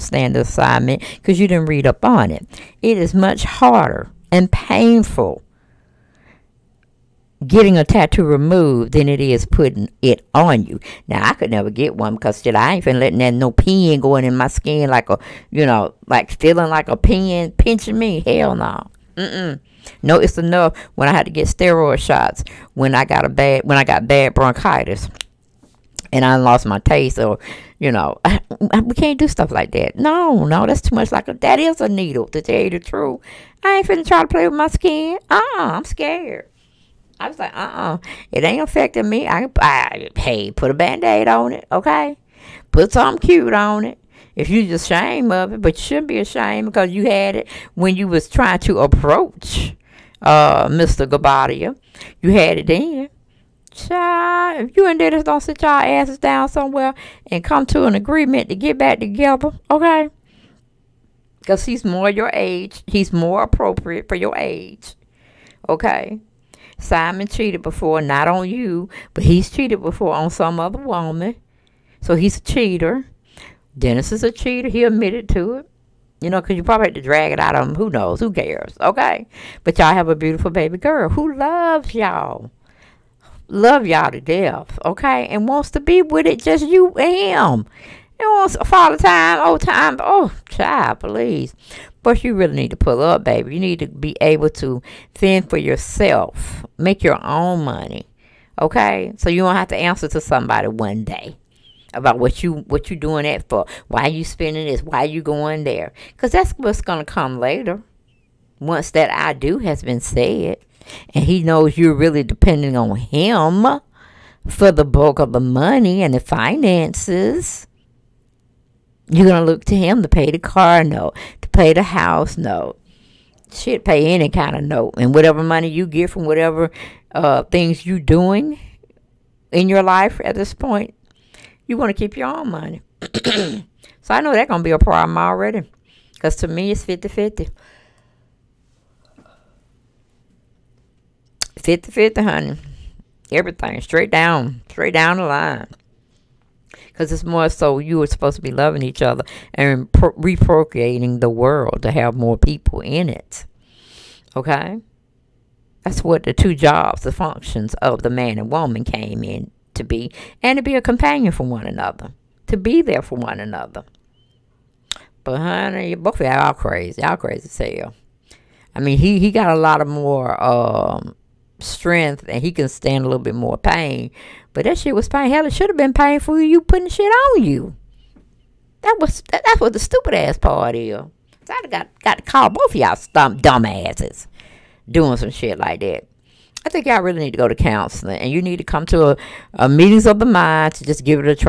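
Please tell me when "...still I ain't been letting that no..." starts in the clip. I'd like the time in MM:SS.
00:12.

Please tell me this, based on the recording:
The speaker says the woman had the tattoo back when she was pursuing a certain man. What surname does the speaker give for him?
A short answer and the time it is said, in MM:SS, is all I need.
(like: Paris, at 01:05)
Guobadia, at 00:51.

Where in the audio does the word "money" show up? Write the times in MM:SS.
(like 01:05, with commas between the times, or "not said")
01:37, 01:55, 02:05, 02:12.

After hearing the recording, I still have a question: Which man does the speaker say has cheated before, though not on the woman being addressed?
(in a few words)
Simon.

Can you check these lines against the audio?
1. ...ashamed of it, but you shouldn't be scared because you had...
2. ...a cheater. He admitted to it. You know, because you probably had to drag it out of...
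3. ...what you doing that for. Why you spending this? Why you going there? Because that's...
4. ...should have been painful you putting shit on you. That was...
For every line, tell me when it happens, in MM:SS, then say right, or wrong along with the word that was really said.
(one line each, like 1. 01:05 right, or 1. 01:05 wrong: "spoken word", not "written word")
1. 00:44 wrong: "ashamed", not "scared"
2. 01:14 right
3. 01:42 right
4. 02:55 right.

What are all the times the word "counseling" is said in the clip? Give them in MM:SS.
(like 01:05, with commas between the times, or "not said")
03:07.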